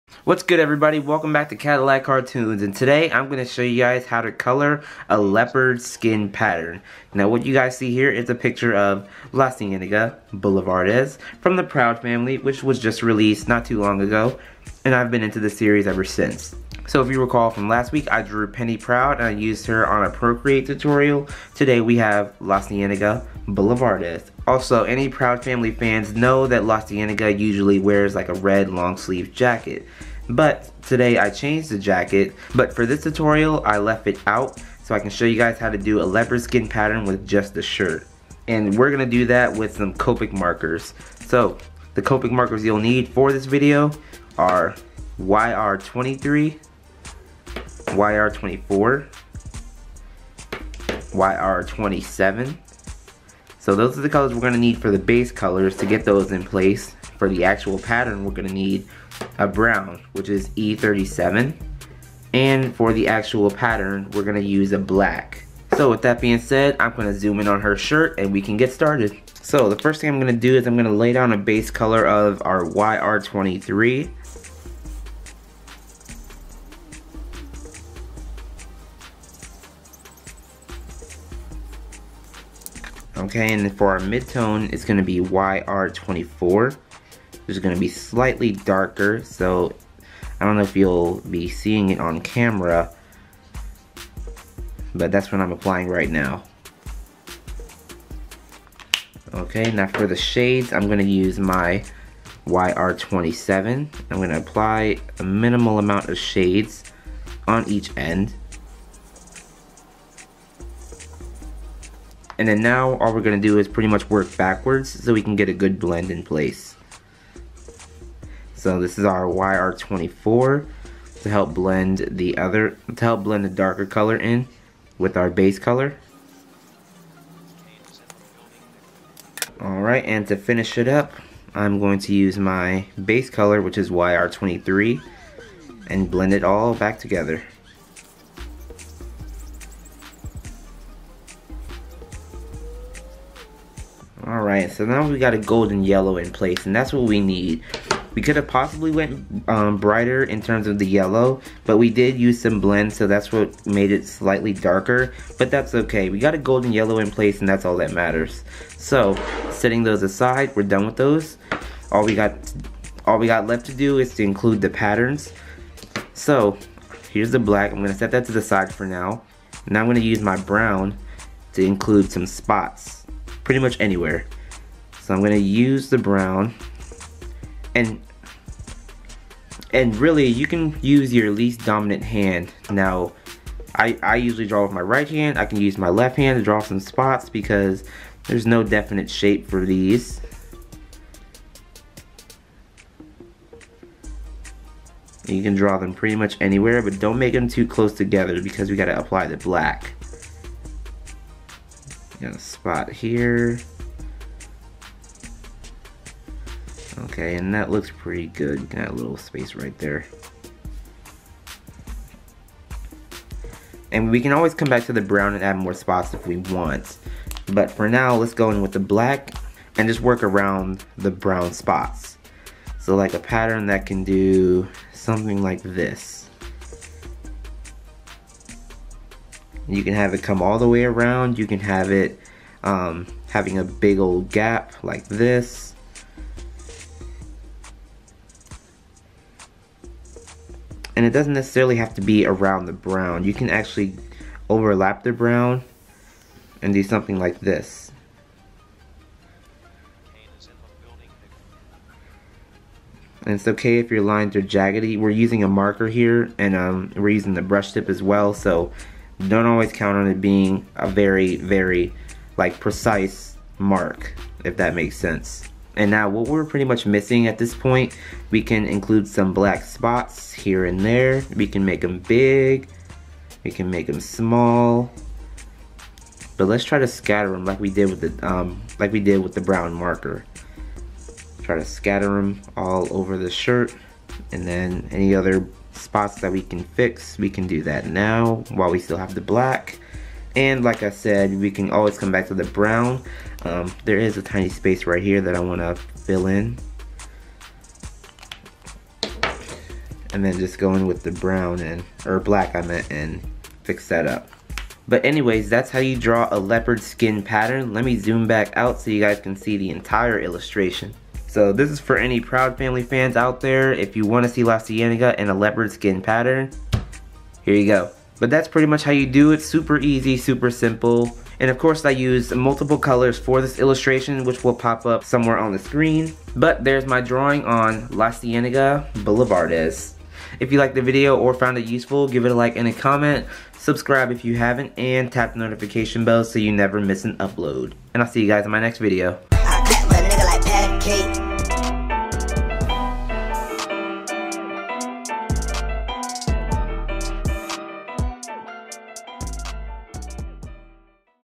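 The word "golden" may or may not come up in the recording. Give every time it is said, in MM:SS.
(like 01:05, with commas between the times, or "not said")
02:25, 02:36.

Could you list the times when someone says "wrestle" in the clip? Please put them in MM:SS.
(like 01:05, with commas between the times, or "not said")
not said.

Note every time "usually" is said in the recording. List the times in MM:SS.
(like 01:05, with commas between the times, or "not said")
00:27, 03:04.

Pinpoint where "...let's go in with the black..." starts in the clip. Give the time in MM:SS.
03:38.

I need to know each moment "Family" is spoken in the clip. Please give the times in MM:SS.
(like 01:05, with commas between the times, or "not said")
00:12, 00:25, 05:12.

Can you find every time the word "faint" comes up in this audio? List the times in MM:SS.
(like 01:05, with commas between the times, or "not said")
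not said.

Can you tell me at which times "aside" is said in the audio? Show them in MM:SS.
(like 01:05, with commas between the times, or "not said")
02:40.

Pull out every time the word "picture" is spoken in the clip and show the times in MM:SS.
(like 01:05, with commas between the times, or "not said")
00:08.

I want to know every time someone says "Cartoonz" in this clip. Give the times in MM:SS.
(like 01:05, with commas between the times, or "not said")
00:02.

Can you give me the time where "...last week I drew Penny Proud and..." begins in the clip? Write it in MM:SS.
00:17.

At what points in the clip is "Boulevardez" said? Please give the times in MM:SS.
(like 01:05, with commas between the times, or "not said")
00:10, 00:23, 05:29.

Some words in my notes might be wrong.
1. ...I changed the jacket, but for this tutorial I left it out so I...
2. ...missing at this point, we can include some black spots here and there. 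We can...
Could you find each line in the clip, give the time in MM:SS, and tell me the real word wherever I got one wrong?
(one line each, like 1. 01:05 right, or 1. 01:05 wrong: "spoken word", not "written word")
1. 00:31 right
2. 04:26 right.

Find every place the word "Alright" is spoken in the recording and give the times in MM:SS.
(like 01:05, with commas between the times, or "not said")
02:09, 02:24.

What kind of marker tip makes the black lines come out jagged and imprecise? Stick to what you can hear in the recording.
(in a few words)
Brush tip.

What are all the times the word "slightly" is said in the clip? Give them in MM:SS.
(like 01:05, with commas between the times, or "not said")
01:27, 02:34.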